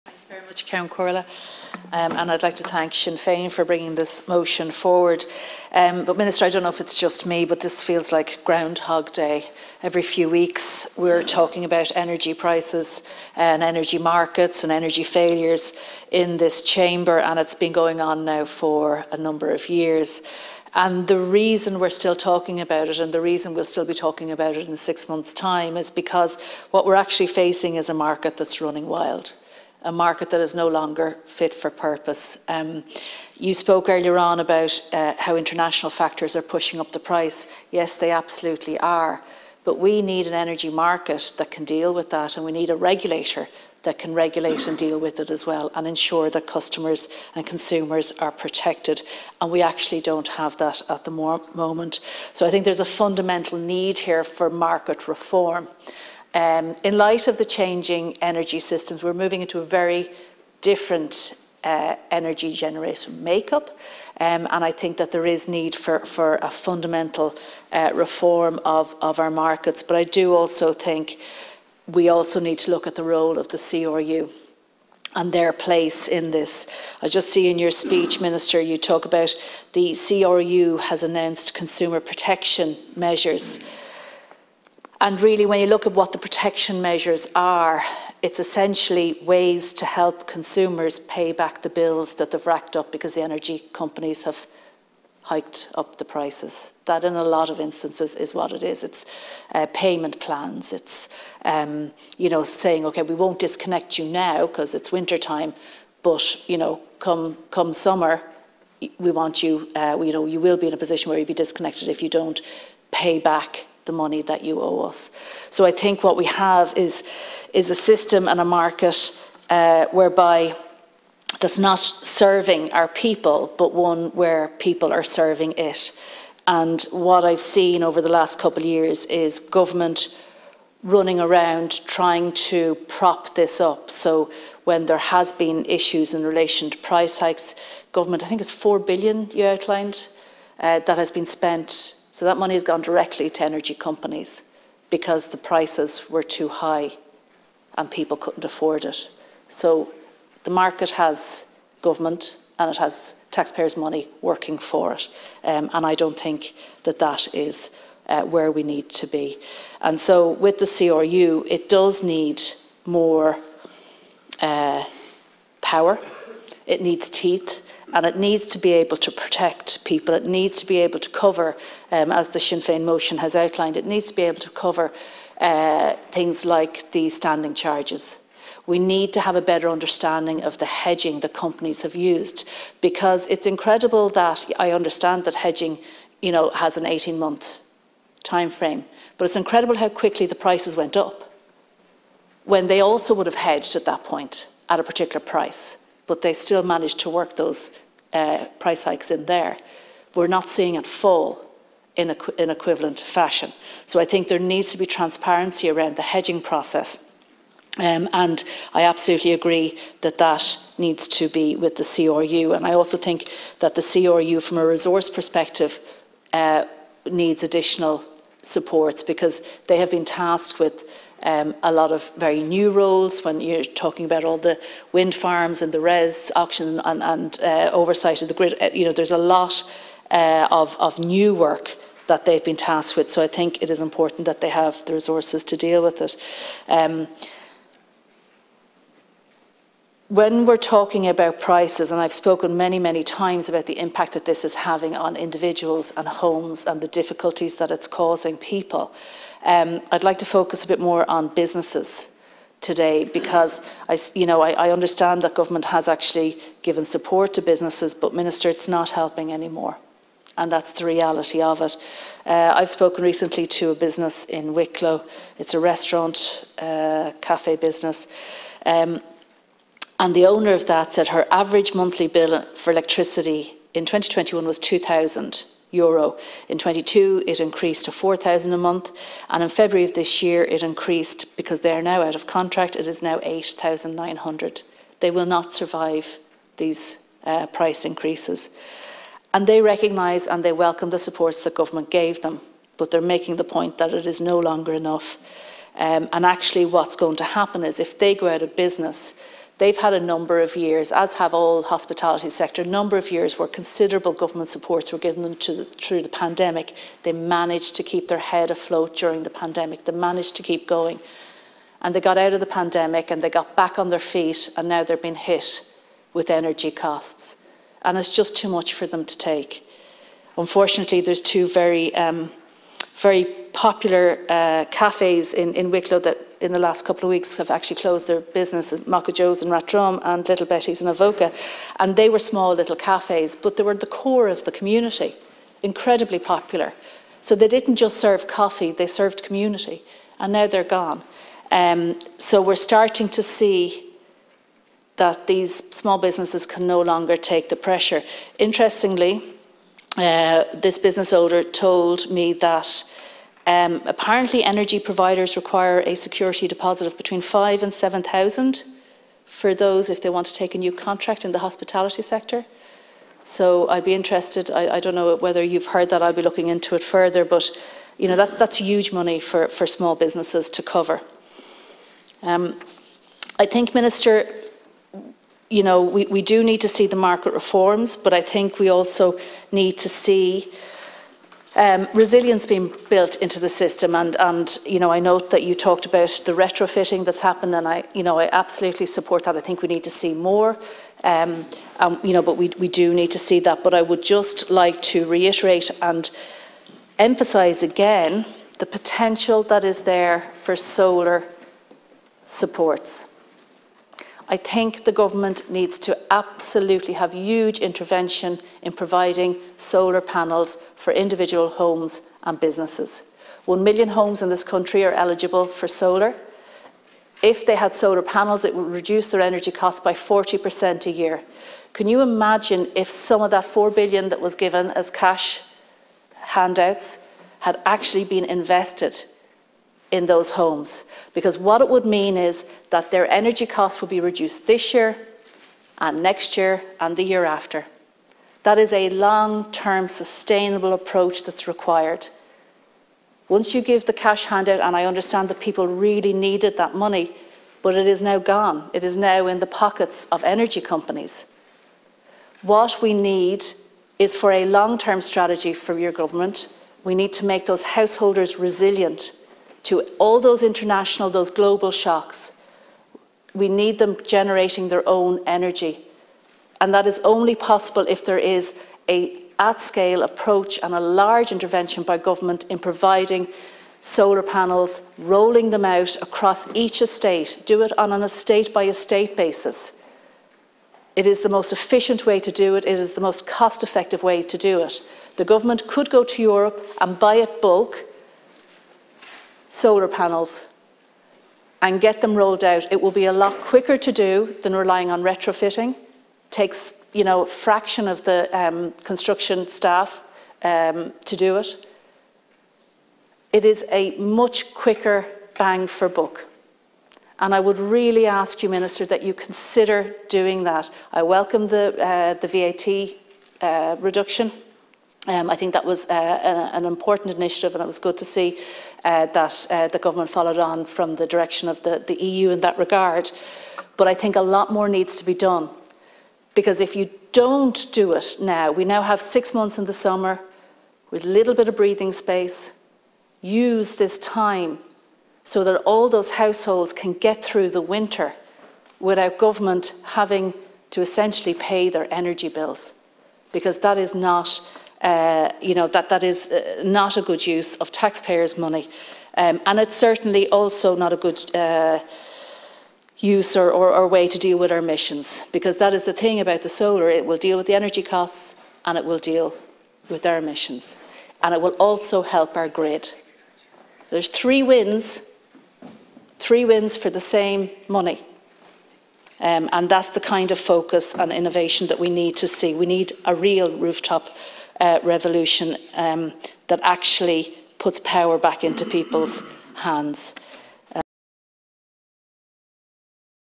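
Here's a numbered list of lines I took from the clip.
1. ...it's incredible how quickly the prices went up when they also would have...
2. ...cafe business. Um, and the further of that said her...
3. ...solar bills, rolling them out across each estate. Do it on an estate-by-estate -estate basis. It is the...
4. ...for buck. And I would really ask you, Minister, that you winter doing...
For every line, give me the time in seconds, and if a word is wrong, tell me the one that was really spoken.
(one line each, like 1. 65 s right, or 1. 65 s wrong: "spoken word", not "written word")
1. 189 s right
2. 267 s wrong: "owner", not "further"
3. 473 s wrong: "panels", not "bills"
4. 505 s wrong: "consider", not "winter".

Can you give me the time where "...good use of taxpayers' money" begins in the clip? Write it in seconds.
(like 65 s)
547 s.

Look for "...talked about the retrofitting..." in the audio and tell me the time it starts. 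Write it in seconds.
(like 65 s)
385 s.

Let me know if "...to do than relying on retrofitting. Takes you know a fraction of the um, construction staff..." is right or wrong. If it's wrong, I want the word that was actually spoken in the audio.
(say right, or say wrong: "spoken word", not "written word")
right.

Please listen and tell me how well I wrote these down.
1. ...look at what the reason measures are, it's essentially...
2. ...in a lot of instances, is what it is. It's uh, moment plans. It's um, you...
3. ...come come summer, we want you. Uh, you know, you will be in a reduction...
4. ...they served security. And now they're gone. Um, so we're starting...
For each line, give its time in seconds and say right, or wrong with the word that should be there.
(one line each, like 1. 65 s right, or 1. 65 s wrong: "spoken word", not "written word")
1. 85 s wrong: "protection", not "reason"
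2. 97 s wrong: "payment", not "moment"
3. 106 s wrong: "position", not "reduction"
4. 338 s wrong: "community", not "security".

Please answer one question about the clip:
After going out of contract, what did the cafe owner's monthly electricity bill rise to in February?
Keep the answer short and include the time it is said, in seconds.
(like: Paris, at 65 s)
8,900, at 283 s.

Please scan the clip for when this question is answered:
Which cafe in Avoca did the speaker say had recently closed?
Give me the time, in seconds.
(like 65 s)
330 s.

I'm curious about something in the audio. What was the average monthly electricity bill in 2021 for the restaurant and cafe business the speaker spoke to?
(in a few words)
2,000 euro.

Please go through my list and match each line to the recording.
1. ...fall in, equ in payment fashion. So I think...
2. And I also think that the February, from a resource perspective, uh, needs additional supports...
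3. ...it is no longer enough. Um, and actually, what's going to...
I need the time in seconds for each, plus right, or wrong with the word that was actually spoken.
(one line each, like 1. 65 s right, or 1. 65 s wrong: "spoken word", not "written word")
1. 200 s wrong: "equivalent", not "payment"
2. 212 s wrong: "CRU", not "February"
3. 293 s right.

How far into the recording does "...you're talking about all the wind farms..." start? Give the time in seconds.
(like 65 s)
223 s.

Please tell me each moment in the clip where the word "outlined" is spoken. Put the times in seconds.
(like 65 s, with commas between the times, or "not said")
139 s, 173 s.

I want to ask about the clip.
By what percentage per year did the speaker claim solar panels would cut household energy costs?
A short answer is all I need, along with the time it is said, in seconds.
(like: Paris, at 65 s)
40%, at 419 s.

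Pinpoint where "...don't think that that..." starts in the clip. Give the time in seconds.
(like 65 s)
155 s.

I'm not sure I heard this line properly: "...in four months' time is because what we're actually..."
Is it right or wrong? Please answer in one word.
wrong.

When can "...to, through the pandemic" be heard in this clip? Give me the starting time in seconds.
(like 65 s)
305 s.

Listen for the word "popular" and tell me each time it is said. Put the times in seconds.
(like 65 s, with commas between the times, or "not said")
323 s, 336 s.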